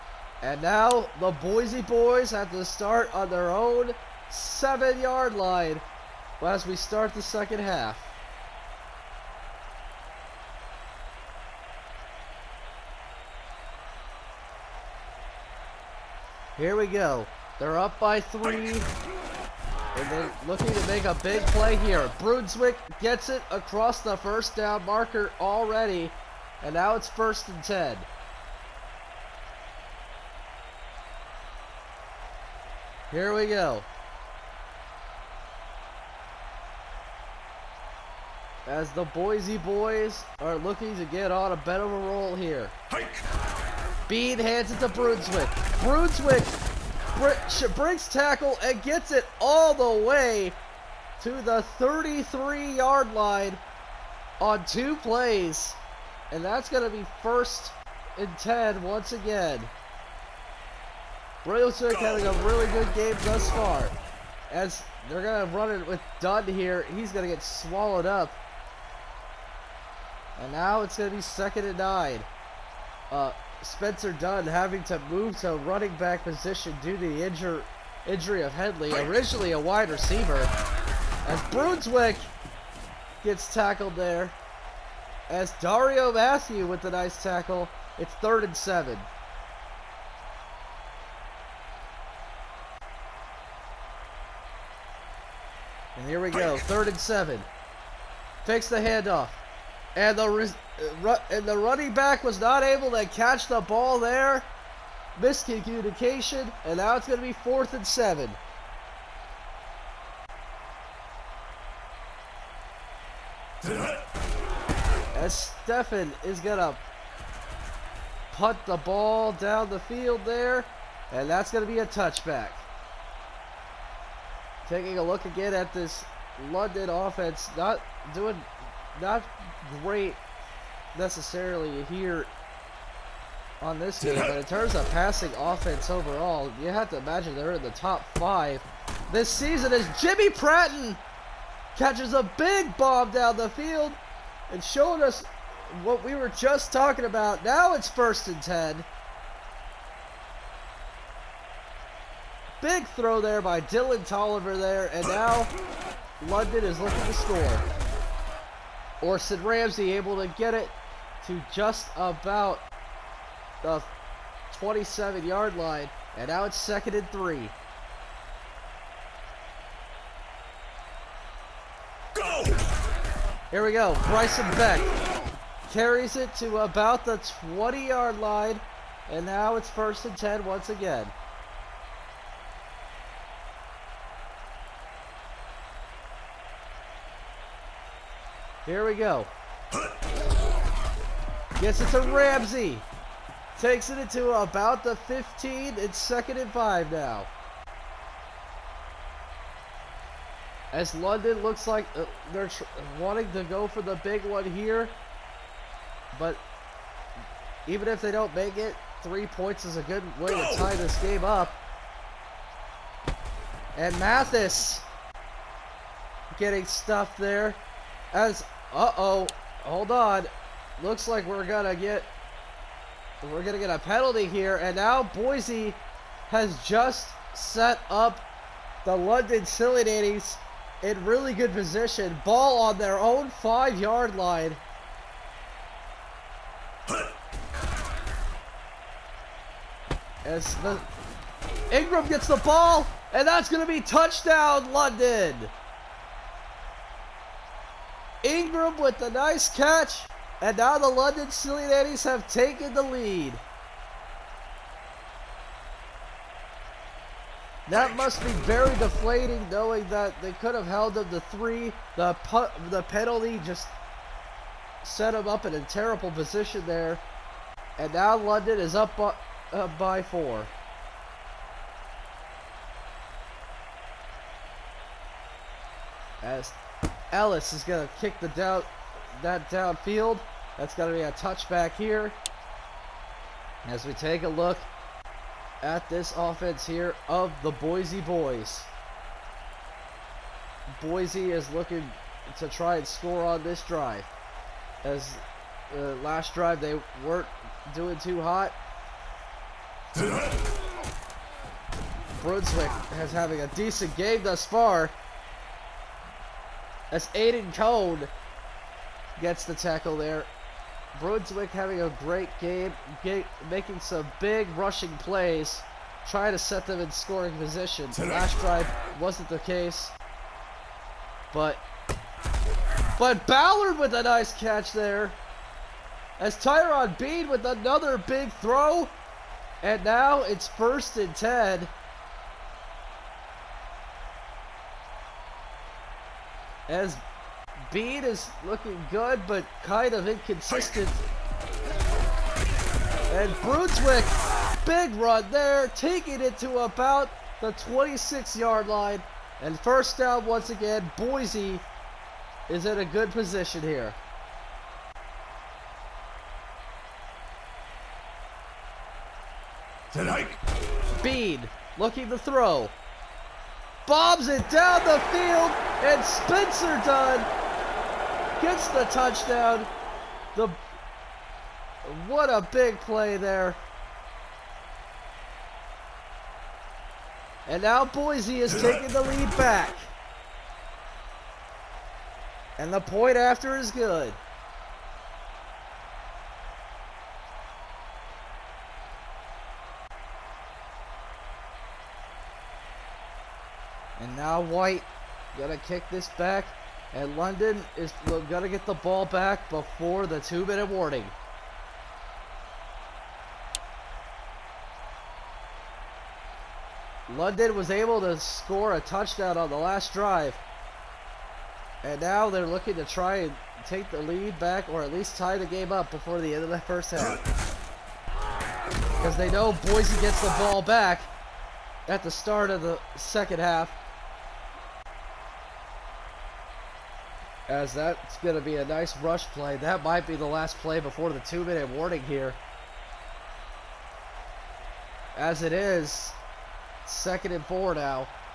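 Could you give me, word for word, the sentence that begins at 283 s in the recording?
As we take a look at this offense here of the Boise Boys.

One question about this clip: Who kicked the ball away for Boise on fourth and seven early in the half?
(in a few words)
Stefan.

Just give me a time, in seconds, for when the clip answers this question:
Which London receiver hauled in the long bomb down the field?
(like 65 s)
140 s.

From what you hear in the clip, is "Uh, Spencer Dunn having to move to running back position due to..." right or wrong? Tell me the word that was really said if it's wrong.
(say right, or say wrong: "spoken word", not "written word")
right.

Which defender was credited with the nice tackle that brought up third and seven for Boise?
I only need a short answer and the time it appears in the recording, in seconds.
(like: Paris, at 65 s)
Dario Matthew, at 85 s.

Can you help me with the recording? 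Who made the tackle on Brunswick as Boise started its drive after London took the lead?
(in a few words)
Aiden Cone.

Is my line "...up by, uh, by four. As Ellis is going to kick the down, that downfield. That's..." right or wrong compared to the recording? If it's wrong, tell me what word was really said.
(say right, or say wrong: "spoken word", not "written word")
right.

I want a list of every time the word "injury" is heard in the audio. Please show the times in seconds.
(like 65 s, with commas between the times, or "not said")
78 s.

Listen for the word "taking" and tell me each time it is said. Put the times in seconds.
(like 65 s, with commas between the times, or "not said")
124 s, 345 s, 378 s.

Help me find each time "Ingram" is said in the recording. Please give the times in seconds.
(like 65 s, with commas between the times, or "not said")
241 s, 248 s.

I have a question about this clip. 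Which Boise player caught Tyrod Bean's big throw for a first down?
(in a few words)
Ballard.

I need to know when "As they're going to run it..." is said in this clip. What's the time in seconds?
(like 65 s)
64 s.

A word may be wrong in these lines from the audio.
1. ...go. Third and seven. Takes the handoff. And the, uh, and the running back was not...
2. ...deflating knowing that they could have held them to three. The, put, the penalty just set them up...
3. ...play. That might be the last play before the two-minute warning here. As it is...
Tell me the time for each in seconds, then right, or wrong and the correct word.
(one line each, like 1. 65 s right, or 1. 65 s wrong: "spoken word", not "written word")
1. 96 s right
2. 258 s right
3. 429 s right.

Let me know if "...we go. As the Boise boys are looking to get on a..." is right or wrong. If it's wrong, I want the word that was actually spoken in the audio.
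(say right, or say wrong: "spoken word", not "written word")
right.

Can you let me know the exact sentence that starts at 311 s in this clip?
Brunswick having a great game, get, making some big rushing plays, trying to set them in scoring position.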